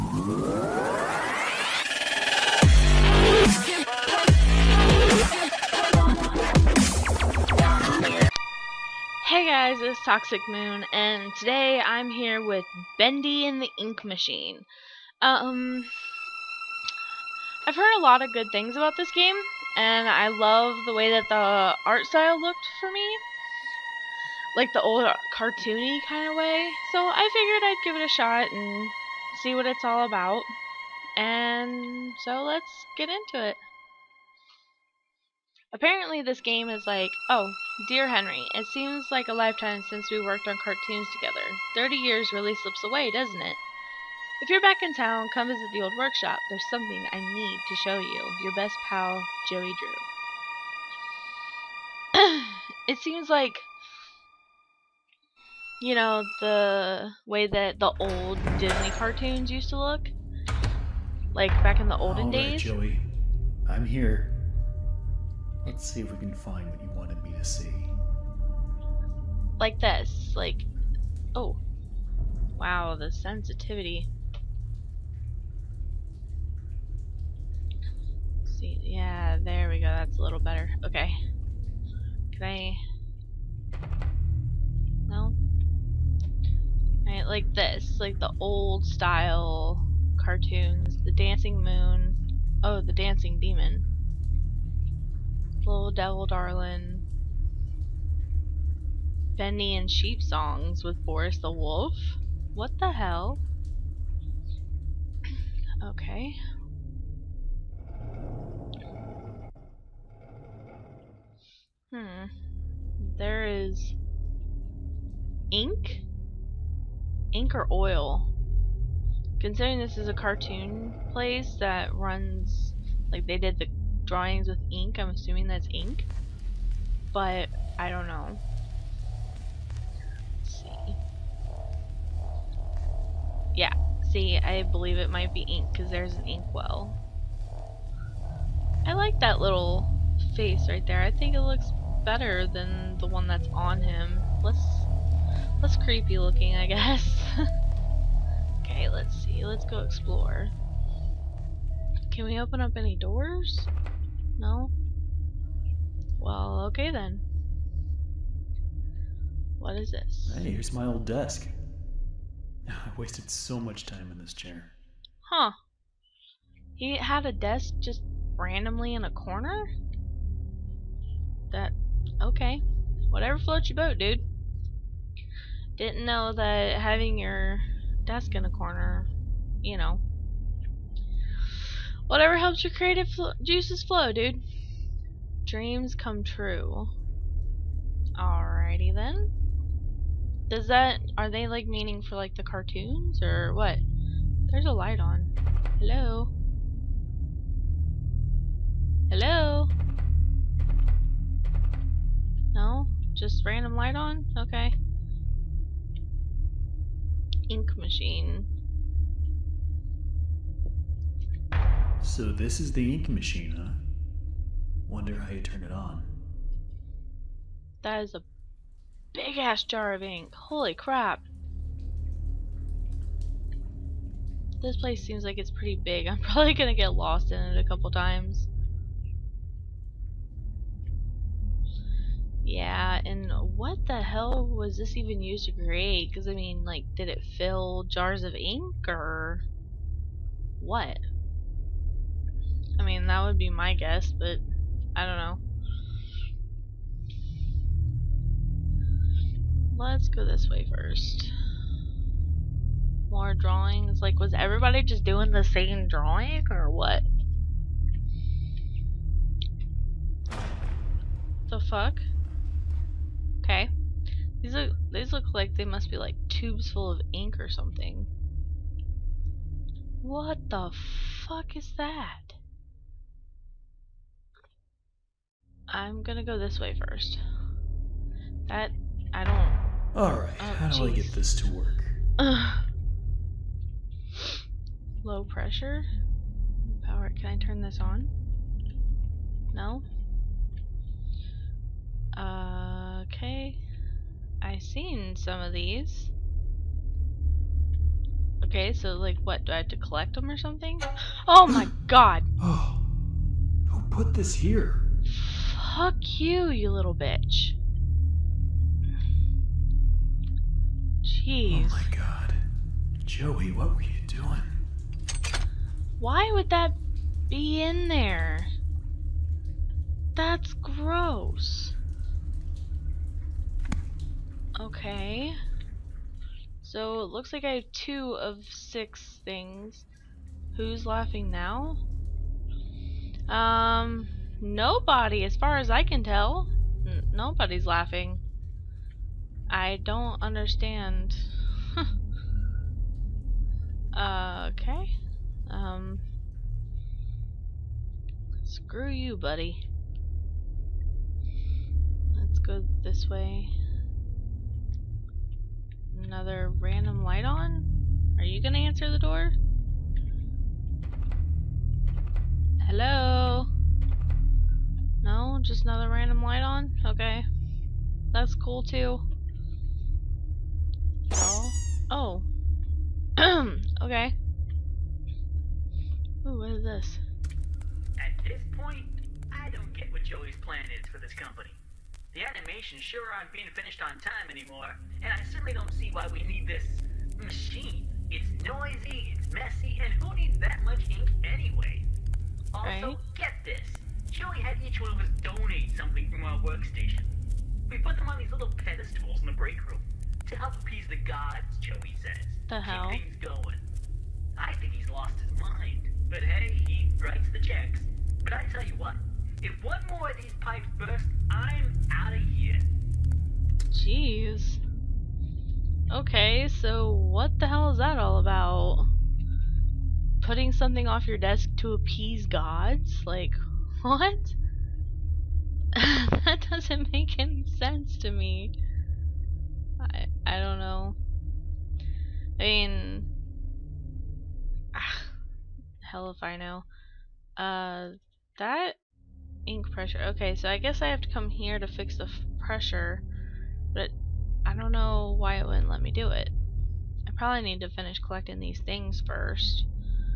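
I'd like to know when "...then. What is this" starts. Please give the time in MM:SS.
02:36.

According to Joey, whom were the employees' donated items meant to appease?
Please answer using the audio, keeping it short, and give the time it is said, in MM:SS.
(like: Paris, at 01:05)
the gods, at 06:40.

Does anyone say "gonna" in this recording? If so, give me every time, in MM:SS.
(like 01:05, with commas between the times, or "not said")
03:46, 04:36, 05:58.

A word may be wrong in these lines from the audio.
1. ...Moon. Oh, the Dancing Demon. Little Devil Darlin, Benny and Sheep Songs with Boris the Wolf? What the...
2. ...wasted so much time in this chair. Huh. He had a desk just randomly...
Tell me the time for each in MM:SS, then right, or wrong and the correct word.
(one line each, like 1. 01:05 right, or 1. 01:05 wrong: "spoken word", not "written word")
1. 01:31 right
2. 02:42 right.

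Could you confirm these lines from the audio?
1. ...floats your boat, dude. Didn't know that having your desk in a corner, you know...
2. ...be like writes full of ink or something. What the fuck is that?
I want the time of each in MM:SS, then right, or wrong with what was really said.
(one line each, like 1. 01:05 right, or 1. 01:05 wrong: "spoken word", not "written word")
1. 02:53 right
2. 04:25 wrong: "tubes", not "writes".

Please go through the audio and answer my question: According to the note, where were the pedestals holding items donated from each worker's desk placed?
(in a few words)
the break room.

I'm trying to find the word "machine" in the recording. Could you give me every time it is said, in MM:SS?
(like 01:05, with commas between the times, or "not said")
00:14, 03:27, 03:33, 06:27.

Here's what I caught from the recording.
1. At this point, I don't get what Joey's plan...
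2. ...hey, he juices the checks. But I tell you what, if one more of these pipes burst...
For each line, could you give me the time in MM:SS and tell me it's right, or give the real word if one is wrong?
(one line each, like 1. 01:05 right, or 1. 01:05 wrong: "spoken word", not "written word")
1. 06:17 right
2. 06:46 wrong: "writes", not "juices".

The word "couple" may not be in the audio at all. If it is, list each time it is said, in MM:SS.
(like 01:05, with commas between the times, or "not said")
03:47.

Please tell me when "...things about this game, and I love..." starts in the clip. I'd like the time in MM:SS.
00:18.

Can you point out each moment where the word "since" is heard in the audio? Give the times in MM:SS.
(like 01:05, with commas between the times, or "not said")
00:39.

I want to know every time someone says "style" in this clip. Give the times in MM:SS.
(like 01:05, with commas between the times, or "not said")
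00:22, 01:28.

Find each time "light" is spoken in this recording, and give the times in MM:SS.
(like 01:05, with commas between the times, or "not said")
03:14, 03:23, 05:57, 06:06.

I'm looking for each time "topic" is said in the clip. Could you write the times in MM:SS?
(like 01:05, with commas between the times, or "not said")
not said.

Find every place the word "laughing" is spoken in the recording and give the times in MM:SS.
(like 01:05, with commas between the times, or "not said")
05:30, 05:37.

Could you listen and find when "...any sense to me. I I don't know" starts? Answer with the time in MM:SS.
07:07.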